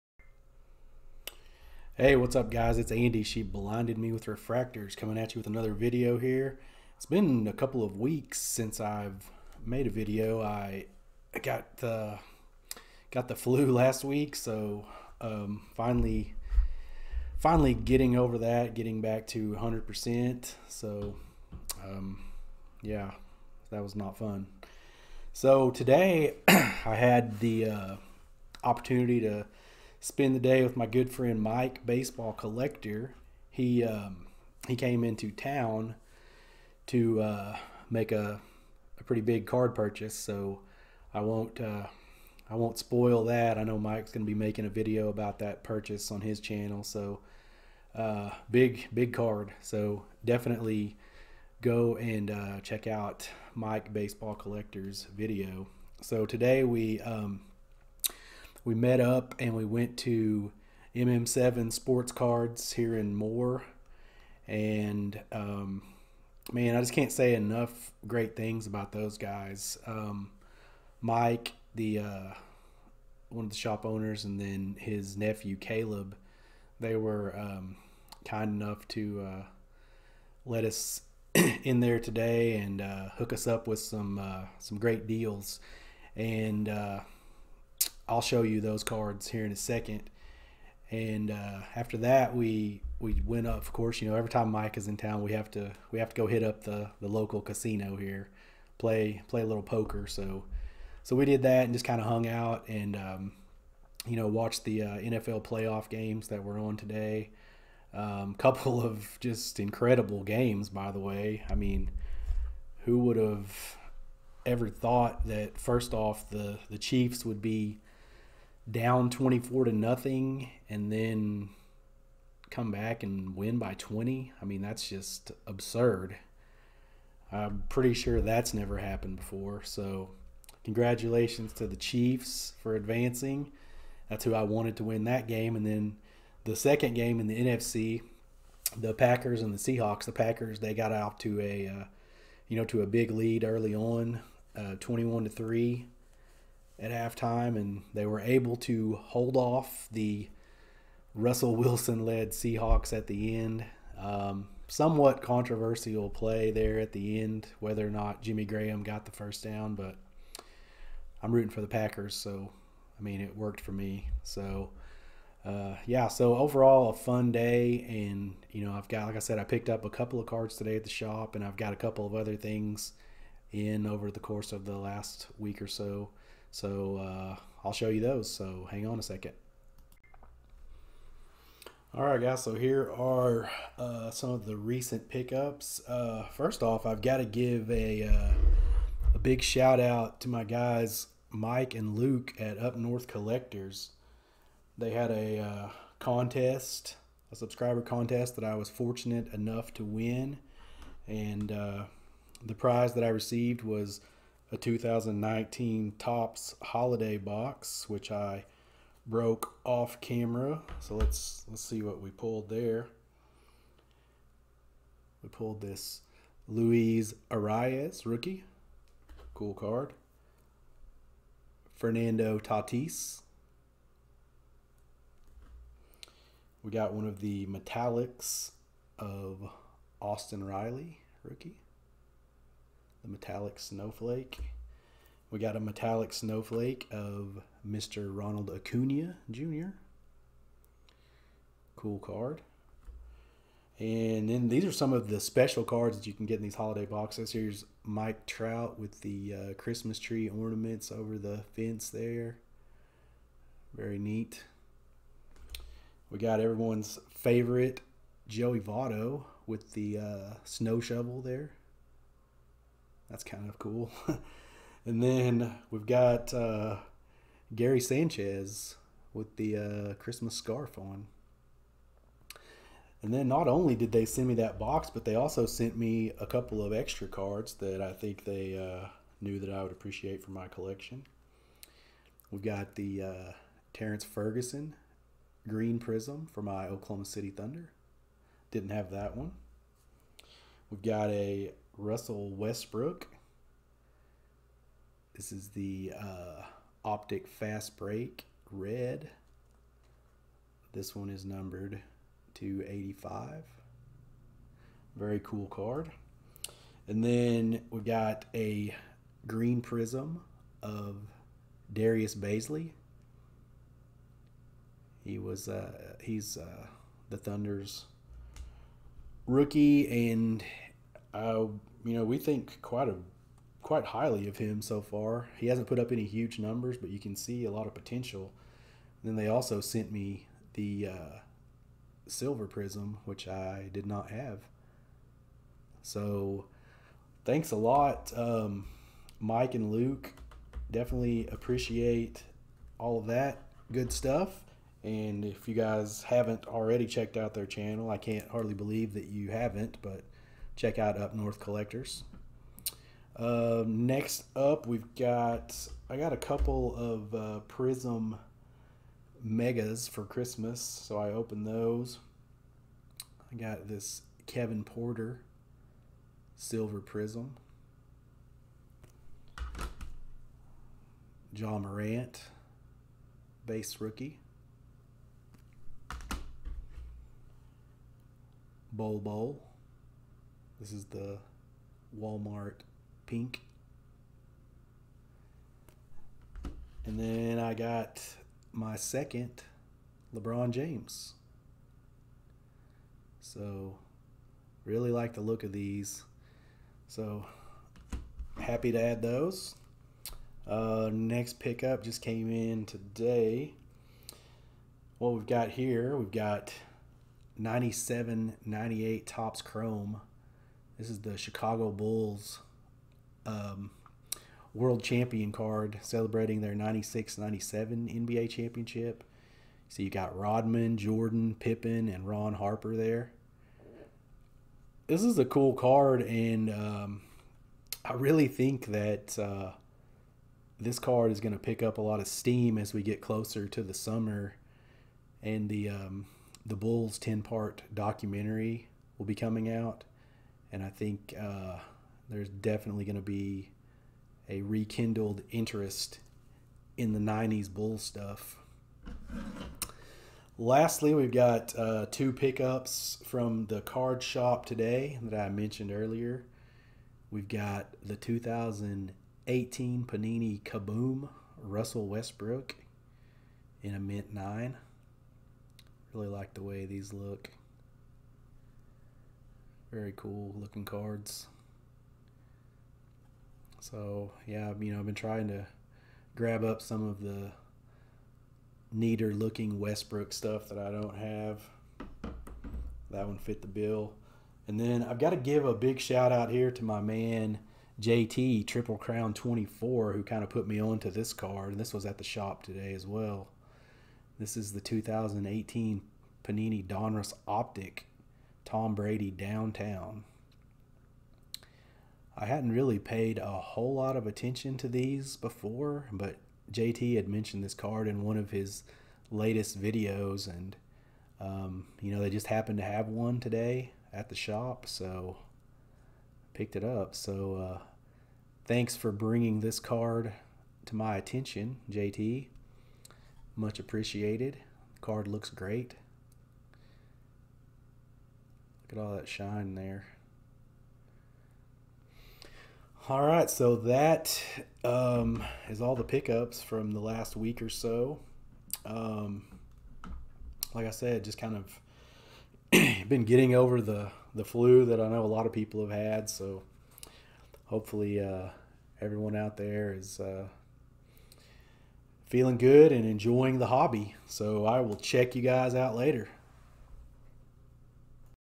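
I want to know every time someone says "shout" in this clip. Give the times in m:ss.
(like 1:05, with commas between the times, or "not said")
3:09, 8:05.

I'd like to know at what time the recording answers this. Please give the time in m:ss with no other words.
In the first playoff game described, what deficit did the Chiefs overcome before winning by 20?
1:59.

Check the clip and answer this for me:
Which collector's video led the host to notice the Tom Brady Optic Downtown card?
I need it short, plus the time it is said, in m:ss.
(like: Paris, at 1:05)
JT Triple Crown 24, at 8:07.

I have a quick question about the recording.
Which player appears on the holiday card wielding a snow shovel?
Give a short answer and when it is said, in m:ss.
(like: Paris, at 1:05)
Joey Votto, at 4:18.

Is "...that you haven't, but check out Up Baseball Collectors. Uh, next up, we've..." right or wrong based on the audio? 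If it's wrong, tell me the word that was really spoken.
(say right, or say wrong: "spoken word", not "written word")
wrong: "North", not "Baseball".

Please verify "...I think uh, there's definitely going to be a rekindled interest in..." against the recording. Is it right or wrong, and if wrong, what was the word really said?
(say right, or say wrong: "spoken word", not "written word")
right.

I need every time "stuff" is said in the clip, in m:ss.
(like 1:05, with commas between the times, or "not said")
5:43, 7:27, 8:00.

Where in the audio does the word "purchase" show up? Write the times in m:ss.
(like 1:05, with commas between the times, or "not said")
0:39, 0:45.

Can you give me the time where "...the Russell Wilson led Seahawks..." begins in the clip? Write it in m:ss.
2:29.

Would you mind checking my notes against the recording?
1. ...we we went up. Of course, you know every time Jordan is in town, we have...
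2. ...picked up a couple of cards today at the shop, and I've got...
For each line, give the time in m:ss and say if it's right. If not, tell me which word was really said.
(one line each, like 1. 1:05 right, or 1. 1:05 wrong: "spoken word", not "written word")
1. 1:32 wrong: "Mike", not "Jordan"
2. 2:49 right.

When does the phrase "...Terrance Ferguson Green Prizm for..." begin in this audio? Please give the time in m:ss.
4:43.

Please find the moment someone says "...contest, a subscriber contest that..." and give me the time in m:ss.
3:15.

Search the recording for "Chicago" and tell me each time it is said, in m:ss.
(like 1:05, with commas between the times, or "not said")
6:51.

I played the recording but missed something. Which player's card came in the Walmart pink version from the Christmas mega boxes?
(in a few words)
Bol Bol.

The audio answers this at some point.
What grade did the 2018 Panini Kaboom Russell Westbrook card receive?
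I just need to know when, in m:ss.
7:43.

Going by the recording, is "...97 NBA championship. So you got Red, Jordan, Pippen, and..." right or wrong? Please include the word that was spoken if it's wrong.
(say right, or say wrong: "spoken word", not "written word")
wrong: "Rodman", not "Red".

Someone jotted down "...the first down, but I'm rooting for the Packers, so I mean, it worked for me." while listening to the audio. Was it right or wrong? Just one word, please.
right.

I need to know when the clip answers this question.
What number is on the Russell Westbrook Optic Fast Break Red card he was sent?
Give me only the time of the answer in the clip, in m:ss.
5:02.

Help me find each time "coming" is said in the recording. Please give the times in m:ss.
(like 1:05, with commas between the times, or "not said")
0:04, 7:19.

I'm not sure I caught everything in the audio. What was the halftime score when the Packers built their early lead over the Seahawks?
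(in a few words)
21 to 3.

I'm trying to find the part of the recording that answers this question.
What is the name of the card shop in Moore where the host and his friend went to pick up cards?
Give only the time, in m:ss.
1:00.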